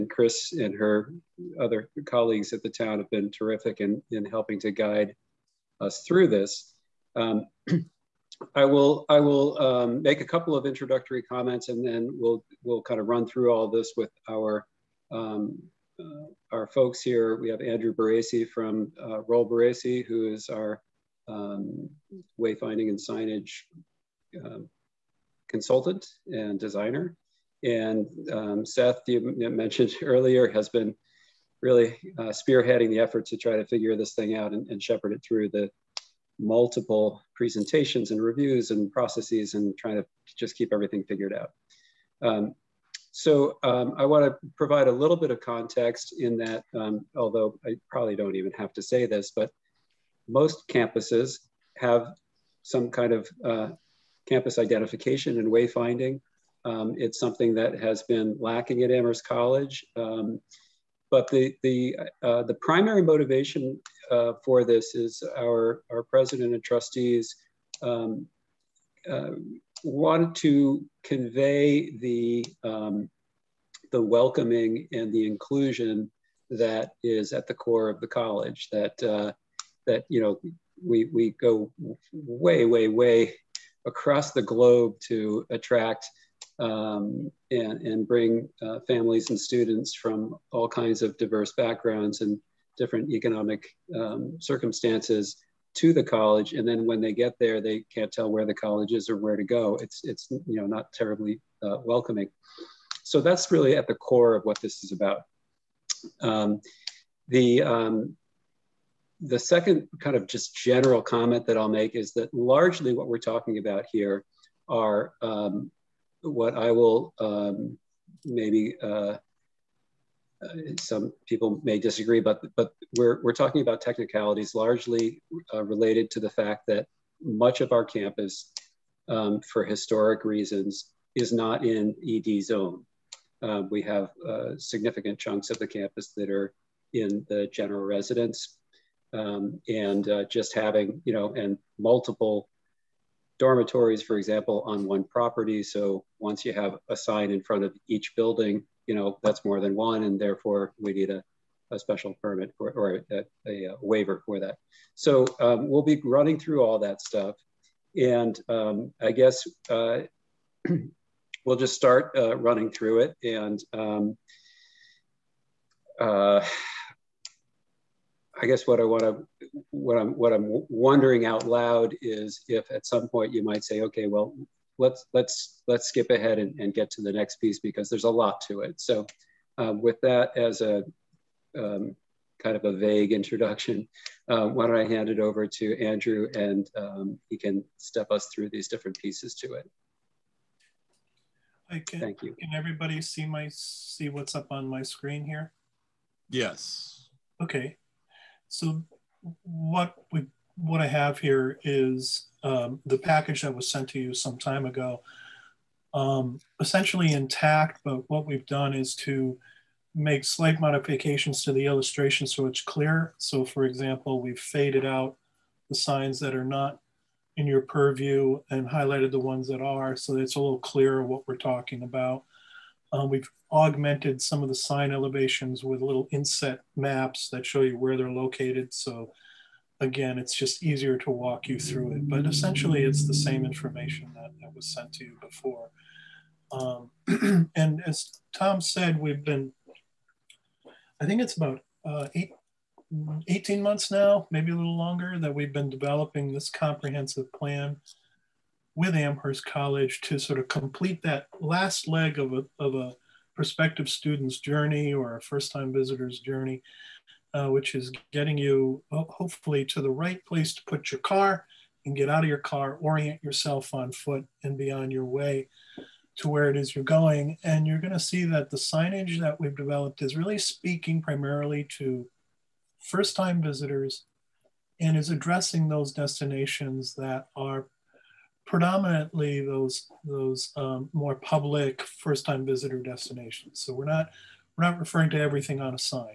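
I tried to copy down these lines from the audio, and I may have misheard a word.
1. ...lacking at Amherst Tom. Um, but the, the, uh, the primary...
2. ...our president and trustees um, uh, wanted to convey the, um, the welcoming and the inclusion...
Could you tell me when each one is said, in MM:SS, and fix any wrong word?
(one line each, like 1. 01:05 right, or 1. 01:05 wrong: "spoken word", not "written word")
1. 00:58 wrong: "College", not "Tom"
2. 01:05 right.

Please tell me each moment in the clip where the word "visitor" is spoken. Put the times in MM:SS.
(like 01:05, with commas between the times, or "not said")
04:15, 04:33, 04:42.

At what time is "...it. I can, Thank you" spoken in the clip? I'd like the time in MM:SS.
03:09.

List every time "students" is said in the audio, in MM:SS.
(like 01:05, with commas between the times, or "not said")
01:29, 04:13.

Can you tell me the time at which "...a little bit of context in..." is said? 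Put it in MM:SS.
00:44.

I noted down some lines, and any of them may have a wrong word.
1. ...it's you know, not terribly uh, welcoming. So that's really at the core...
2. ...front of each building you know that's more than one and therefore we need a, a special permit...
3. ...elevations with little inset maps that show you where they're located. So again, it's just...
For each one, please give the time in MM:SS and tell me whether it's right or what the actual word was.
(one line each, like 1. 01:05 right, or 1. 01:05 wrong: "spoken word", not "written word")
1. 01:40 right
2. 02:27 right
3. 03:44 right.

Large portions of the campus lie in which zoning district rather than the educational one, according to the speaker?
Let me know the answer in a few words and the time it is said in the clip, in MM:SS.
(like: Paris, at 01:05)
General residence, at 02:17.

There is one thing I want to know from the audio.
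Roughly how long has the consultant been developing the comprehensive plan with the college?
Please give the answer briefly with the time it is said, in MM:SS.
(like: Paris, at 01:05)
18 months, at 04:03.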